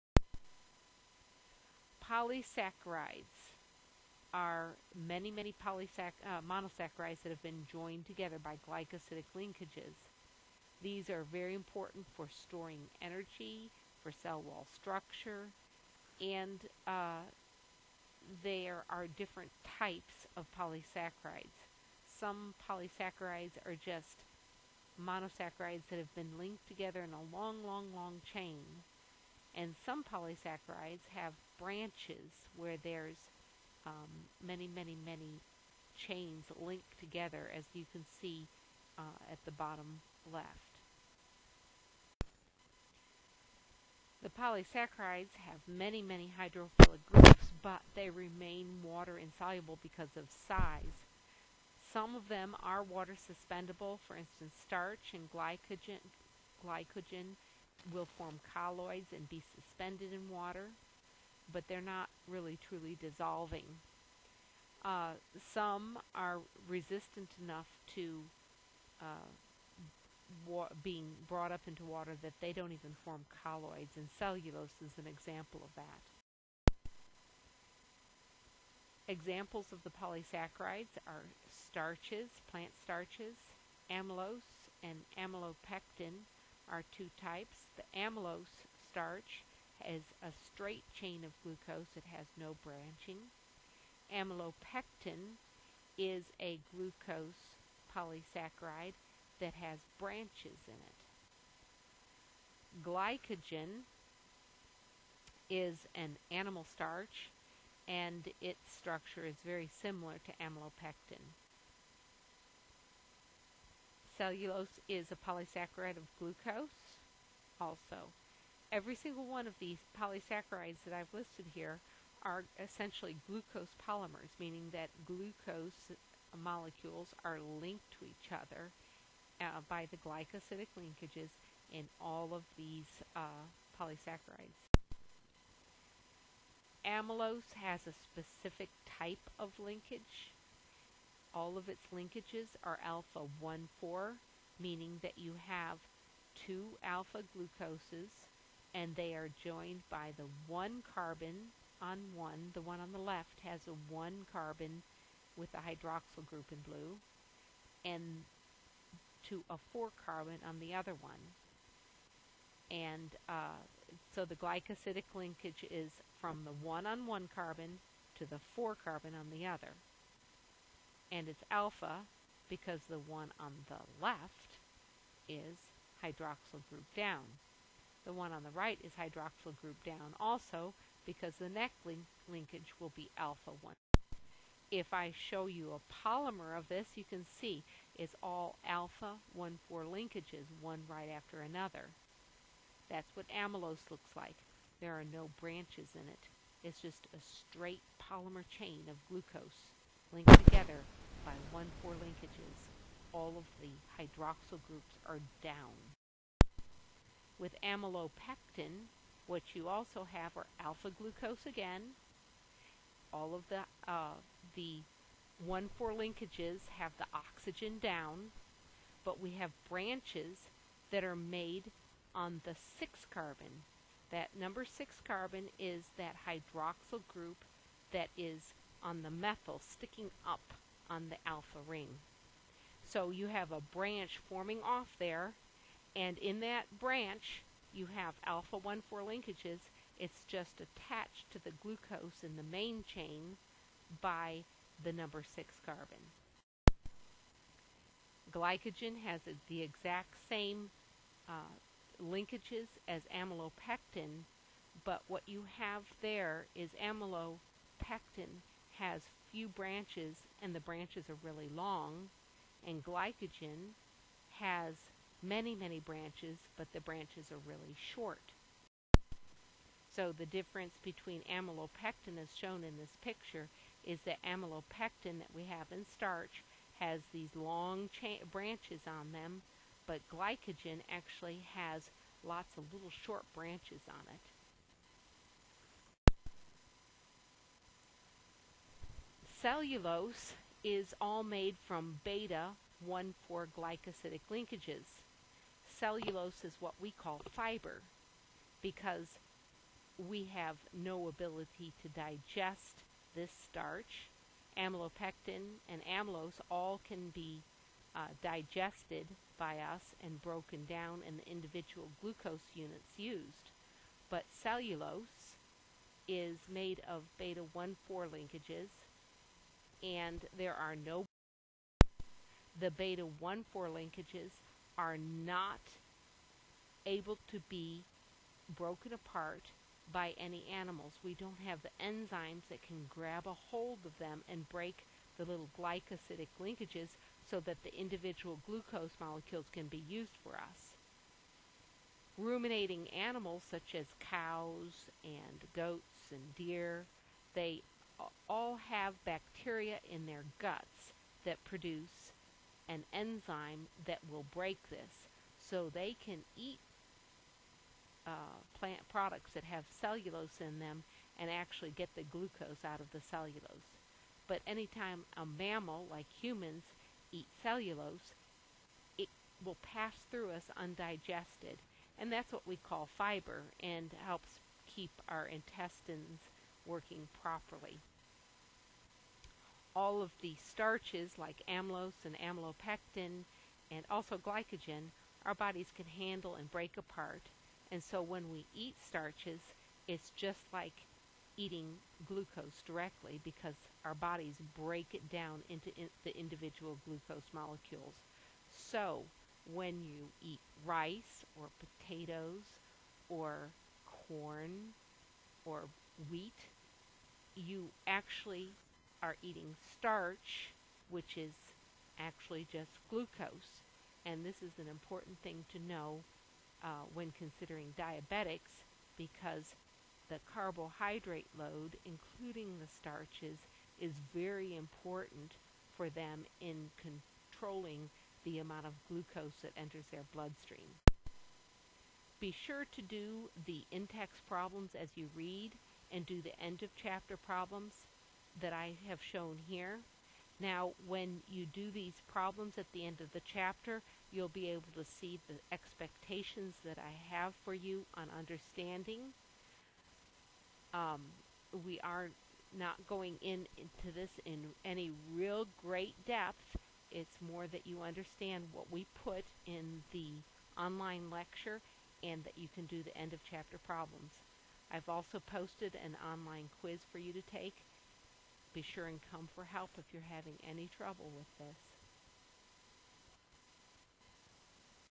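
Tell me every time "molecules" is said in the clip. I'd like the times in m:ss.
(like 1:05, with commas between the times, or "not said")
2:06, 5:38, 6:37.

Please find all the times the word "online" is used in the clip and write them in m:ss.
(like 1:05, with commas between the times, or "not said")
7:40, 7:46.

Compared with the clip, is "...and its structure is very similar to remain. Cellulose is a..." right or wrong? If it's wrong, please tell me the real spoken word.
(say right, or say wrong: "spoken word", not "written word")
wrong: "amylopectin", not "remain".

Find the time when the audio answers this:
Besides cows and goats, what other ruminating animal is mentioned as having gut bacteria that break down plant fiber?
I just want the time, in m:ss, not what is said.
5:46.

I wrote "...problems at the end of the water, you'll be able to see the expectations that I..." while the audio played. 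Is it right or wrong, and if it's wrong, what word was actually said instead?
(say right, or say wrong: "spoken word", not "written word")
wrong: "chapter", not "water".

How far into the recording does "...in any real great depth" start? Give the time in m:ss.
7:34.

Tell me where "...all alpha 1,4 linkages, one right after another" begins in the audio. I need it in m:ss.
3:08.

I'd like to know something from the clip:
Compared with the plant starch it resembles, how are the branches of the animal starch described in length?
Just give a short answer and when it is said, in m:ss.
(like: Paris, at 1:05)
Really short, at 4:26.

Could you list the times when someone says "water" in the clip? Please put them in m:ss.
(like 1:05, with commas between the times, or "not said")
0:48, 0:52, 1:00, 1:11.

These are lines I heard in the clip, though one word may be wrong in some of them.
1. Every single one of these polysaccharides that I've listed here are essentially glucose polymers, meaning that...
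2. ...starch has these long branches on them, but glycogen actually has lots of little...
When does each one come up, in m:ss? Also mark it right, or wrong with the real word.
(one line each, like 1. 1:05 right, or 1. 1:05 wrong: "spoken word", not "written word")
1. 1:58 right
2. 4:35 right.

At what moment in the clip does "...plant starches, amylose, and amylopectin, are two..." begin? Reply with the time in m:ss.
1:22.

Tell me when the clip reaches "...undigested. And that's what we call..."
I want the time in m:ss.
6:10.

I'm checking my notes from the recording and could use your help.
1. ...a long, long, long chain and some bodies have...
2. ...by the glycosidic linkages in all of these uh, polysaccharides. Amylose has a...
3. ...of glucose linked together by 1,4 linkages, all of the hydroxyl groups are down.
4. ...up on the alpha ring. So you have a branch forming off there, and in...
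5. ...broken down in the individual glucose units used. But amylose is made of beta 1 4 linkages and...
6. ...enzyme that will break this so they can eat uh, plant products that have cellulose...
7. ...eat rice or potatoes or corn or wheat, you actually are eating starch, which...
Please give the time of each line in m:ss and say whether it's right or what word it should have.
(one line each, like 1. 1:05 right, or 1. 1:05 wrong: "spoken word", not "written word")
1. 0:27 wrong: "polysaccharides", not "bodies"
2. 2:09 right
3. 3:18 right
4. 3:50 right
5. 5:10 wrong: "cellulose", not "amylose"
6. 5:52 right
7. 6:40 right.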